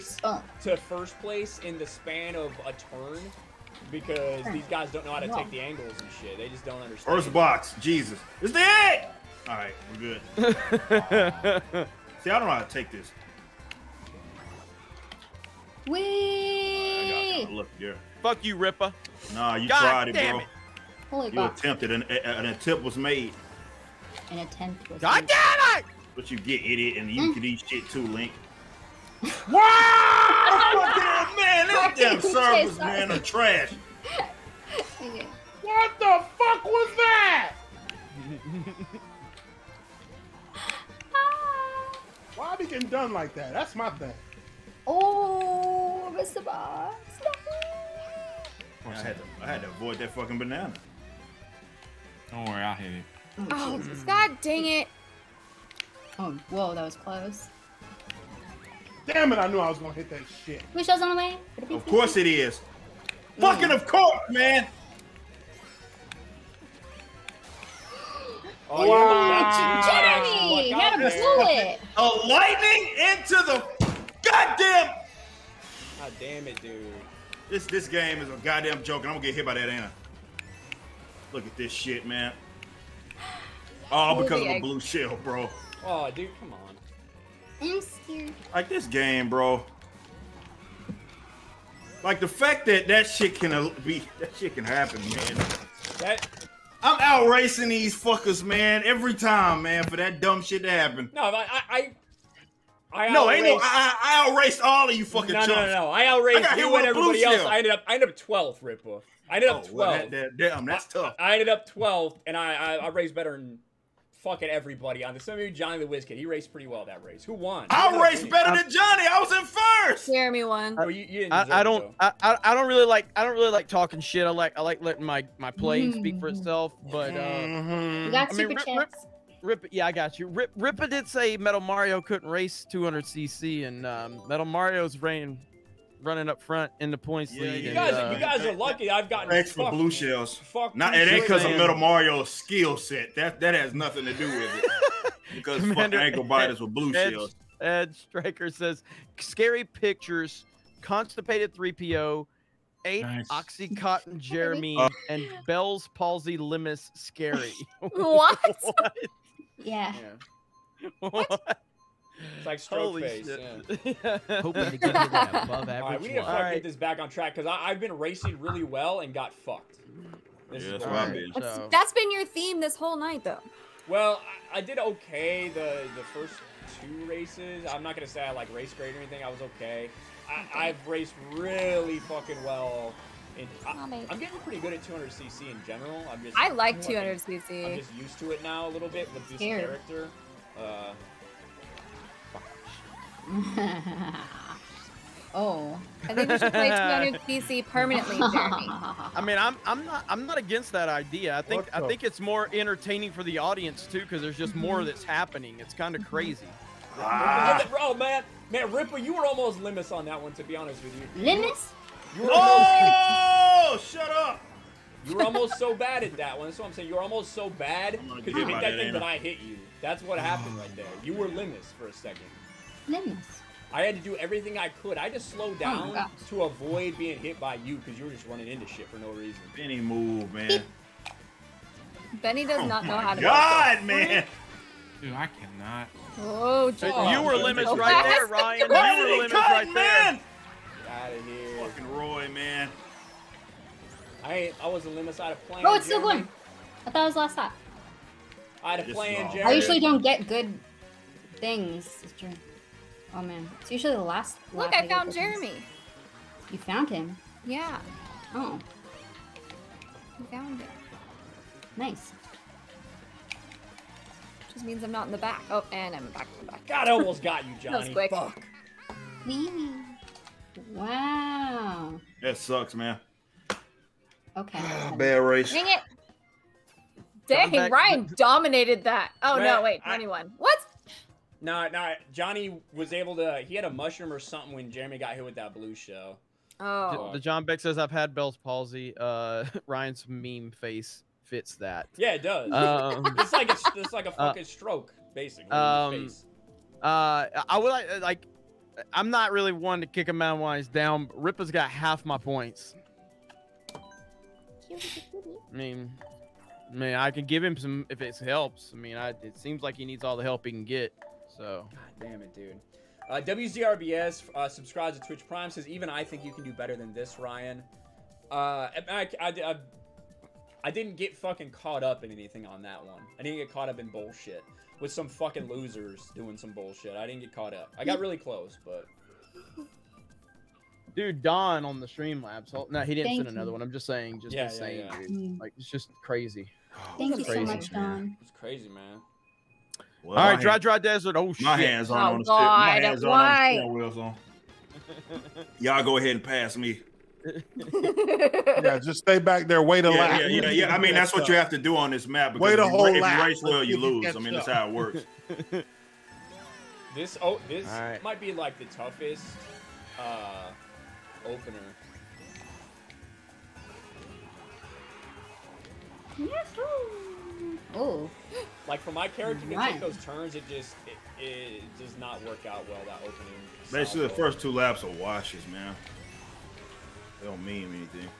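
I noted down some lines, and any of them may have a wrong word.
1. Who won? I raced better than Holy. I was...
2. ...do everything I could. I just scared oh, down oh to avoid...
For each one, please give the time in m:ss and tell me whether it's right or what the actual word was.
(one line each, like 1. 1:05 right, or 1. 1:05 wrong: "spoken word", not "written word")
1. 1:57 wrong: "Johnny", not "Holy"
2. 3:44 wrong: "slowed", not "scared".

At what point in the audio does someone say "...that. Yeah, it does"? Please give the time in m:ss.
4:51.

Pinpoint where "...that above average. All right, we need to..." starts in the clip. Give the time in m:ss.
2:44.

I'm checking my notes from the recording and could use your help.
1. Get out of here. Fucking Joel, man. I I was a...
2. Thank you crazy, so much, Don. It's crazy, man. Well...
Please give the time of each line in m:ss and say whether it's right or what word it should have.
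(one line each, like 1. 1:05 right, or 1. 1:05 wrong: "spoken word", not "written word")
1. 4:00 wrong: "Roy", not "Joel"
2. 5:36 right.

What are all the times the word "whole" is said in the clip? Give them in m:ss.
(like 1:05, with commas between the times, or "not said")
2:52, 5:52.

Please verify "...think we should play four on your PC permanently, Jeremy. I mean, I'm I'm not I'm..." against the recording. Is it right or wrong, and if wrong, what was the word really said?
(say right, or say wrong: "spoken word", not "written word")
wrong: "two", not "four".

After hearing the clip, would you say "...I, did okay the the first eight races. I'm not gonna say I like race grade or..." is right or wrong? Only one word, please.
wrong.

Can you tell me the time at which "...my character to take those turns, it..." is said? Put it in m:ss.
6:08.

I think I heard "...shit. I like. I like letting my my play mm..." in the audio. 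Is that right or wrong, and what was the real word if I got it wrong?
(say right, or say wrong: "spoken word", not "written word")
right.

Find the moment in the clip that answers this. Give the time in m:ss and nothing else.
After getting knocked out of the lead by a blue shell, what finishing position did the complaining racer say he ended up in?
1:47.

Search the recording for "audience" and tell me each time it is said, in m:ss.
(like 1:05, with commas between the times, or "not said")
3:23.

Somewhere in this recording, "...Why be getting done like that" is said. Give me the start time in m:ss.
0:42.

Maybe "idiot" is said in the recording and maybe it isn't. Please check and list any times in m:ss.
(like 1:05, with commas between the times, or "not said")
0:26.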